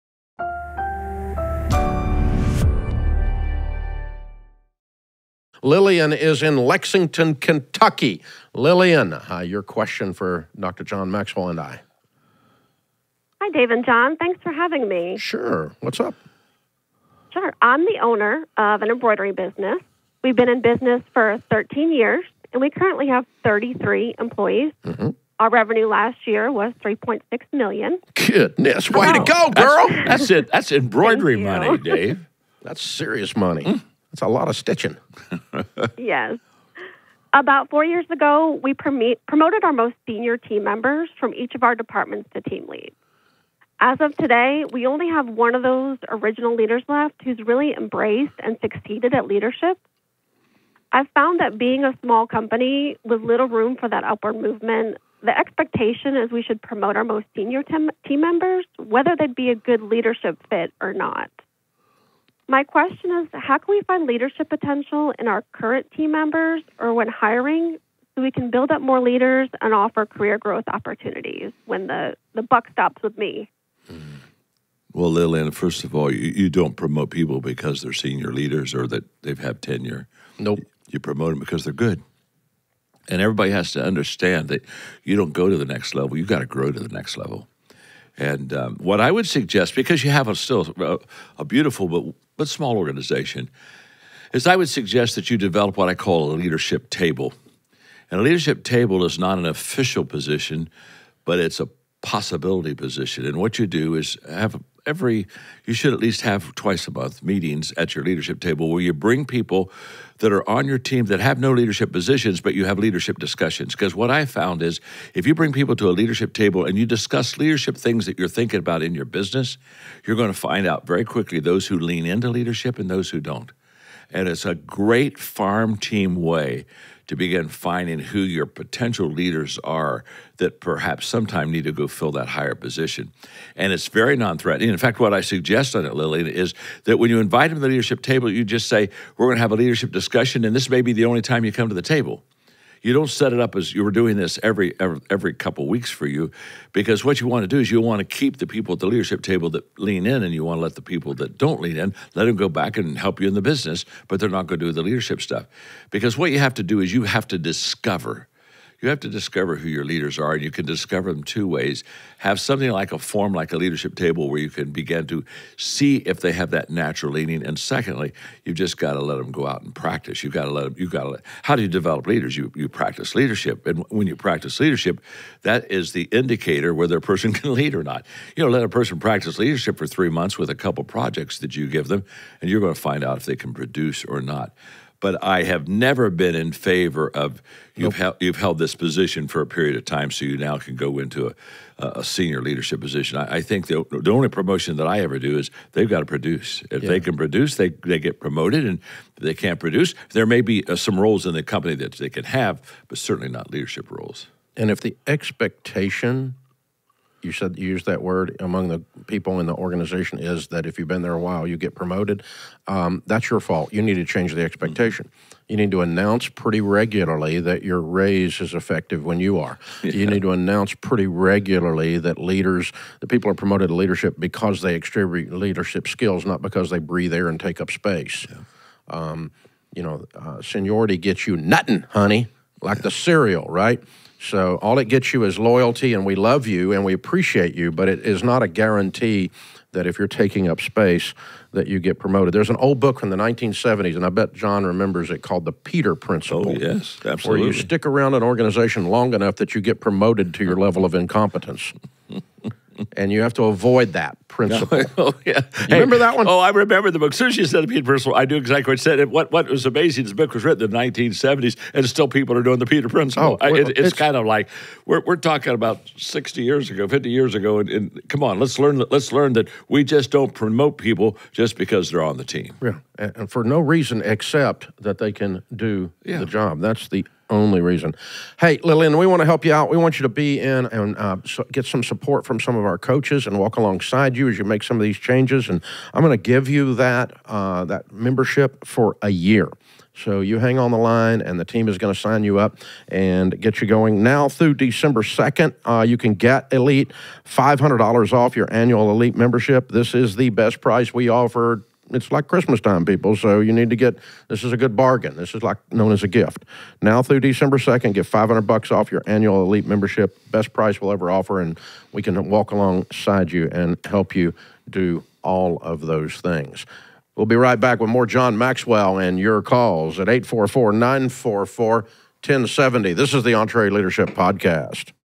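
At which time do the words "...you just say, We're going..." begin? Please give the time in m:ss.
2:18.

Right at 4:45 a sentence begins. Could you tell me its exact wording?
And I'm going to give you that uh, that membership for a year.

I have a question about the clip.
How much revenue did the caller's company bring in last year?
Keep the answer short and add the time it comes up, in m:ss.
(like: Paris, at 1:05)
$3.6 million, at 0:26.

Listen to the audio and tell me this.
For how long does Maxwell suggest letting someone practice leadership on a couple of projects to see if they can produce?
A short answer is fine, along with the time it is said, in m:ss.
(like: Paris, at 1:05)
Three months, at 2:59.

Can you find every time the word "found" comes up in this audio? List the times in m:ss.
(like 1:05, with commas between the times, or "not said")
0:51, 1:54.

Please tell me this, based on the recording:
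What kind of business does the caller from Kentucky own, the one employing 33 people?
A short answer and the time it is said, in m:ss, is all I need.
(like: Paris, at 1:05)
Embroidery business, at 0:18.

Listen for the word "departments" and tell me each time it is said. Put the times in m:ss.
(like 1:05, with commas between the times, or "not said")
0:41.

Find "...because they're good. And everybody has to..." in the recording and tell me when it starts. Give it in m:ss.
1:21.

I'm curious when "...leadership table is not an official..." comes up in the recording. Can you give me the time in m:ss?
1:38.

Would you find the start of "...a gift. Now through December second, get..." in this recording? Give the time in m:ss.
5:06.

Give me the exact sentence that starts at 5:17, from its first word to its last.
We'll be right back with more John Maxwell and your calls at 844 944 1070.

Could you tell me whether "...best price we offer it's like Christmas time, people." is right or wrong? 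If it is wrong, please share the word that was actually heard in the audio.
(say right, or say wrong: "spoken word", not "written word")
right.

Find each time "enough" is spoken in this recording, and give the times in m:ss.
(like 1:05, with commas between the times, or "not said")
4:09.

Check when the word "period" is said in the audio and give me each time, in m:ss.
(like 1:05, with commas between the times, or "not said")
3:09.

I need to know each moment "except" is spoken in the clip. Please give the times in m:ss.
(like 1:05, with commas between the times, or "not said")
4:34.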